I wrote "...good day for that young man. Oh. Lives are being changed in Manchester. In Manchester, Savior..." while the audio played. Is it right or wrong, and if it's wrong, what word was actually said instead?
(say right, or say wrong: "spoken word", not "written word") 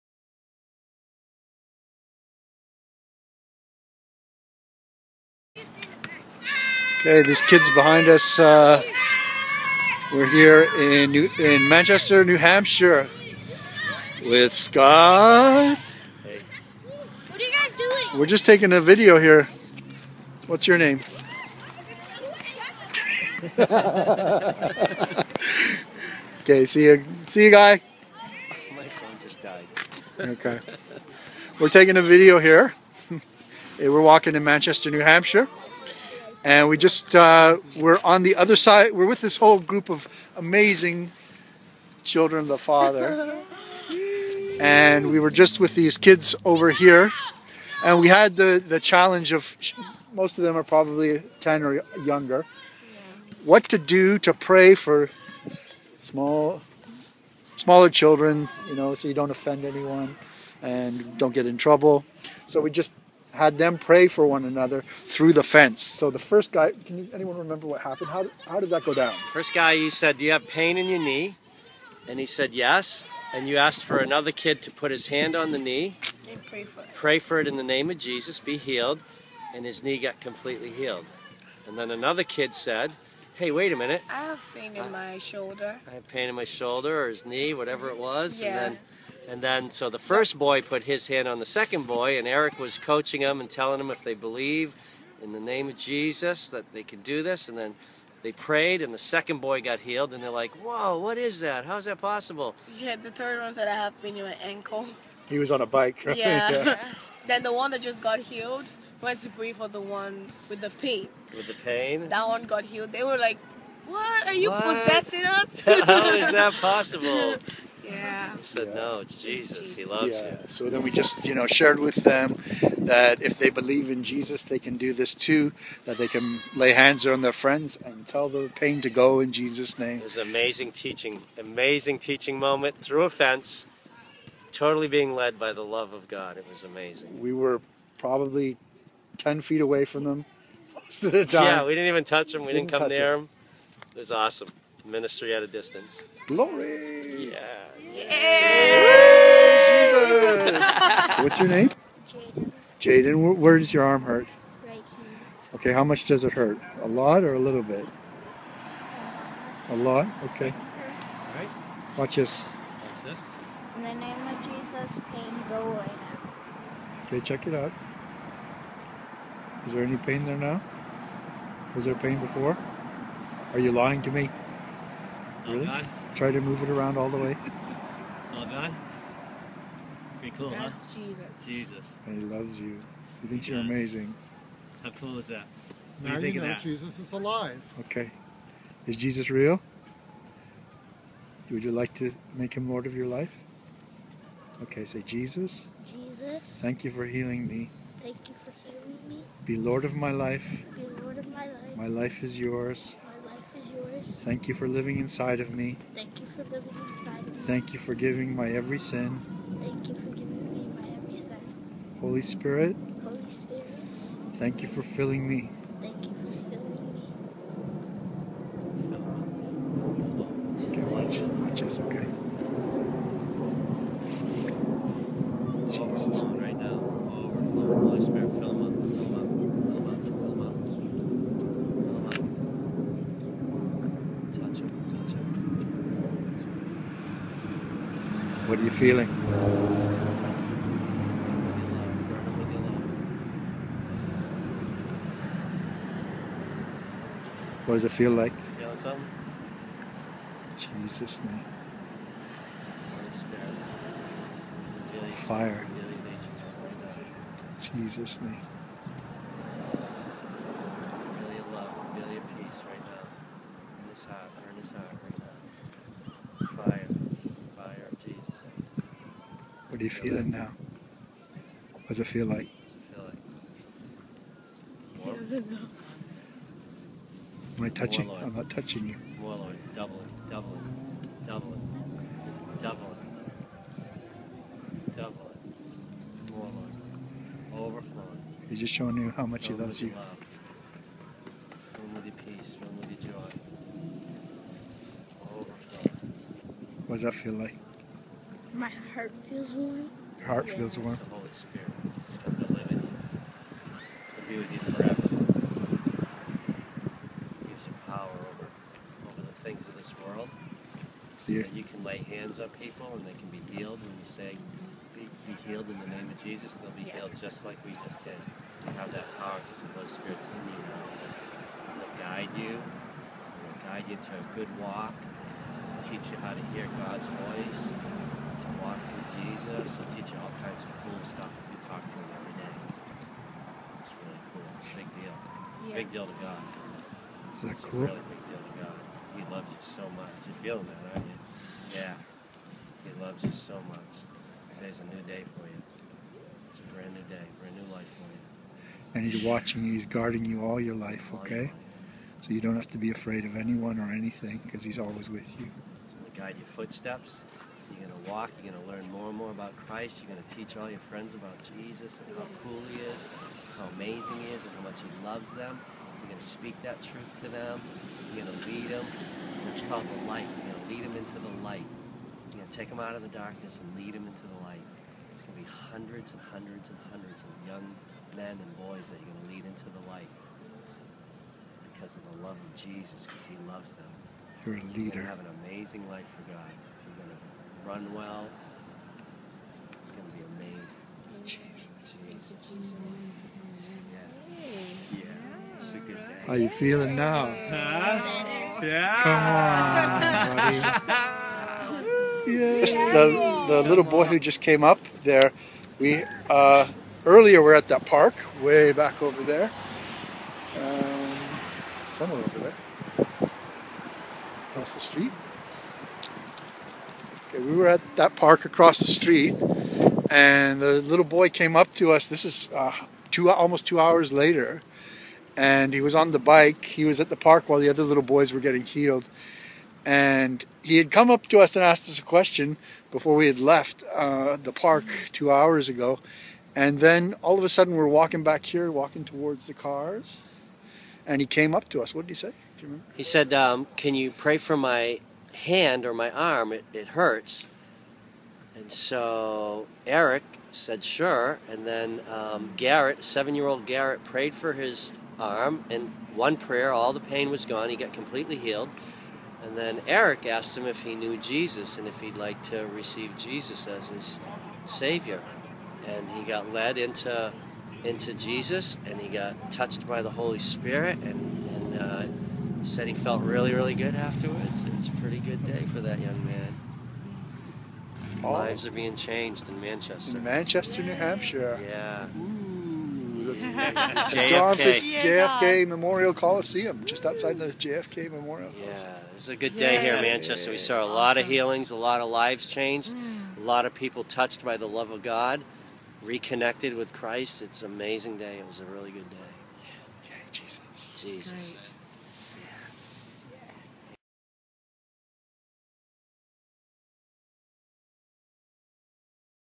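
wrong: "New", not "Savior".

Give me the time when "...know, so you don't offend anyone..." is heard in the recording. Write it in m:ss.
0:58.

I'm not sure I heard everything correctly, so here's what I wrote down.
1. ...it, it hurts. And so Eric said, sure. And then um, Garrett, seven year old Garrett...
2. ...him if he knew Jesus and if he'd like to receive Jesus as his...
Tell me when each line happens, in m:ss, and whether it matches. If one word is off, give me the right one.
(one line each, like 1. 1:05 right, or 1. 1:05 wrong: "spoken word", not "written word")
1. 7:26 right
2. 7:40 right.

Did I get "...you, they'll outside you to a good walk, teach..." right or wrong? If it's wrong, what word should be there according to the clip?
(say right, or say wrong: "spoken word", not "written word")
wrong: "guide", not "outside".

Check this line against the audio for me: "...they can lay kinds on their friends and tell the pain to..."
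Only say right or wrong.
wrong.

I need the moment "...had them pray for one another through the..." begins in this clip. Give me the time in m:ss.
1:03.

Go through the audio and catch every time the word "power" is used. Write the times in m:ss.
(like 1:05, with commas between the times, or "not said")
5:07, 5:19.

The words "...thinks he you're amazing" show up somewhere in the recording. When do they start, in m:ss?
3:03.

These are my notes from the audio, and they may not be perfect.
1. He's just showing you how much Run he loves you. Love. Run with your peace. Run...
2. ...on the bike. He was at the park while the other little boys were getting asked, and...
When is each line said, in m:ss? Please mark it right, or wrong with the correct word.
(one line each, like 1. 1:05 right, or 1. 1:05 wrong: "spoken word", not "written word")
1. 4:48 right
2. 7:05 wrong: "healed", not "asked".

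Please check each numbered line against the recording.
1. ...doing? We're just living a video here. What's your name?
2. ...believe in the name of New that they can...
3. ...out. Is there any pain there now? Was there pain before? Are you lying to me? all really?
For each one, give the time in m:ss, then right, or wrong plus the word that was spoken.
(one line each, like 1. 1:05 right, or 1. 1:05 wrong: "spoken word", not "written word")
1. 0:17 wrong: "taking", not "living"
2. 1:34 wrong: "Jesus", not "New"
3. 2:47 right.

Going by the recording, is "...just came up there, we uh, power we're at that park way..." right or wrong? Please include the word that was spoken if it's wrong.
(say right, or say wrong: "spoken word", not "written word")
wrong: "earlier", not "power".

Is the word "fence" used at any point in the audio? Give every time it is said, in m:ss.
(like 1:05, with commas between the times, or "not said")
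1:05, 2:13.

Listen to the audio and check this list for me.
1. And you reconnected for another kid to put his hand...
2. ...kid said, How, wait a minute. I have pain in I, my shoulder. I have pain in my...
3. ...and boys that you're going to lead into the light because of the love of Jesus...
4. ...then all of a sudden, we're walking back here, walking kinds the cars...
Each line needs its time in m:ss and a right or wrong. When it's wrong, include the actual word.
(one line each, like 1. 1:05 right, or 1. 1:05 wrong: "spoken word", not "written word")
1. 1:13 wrong: "asked", not "reconnected"
2. 1:22 wrong: "Hey", not "How"
3. 6:18 right
4. 7:16 wrong: "towards", not "kinds".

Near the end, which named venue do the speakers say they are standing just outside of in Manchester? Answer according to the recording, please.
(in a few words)
JFK Memorial Coliseum.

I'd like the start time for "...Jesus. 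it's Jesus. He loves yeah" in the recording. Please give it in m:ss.
1:59.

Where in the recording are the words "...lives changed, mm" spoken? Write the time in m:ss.
8:12.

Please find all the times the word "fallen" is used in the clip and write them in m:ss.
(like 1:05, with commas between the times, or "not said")
not said.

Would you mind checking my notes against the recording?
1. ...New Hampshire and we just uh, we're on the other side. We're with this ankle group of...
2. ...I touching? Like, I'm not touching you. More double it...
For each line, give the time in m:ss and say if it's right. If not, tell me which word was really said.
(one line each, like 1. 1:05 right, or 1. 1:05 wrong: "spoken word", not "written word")
1. 0:34 wrong: "whole", not "ankle"
2. 4:37 right.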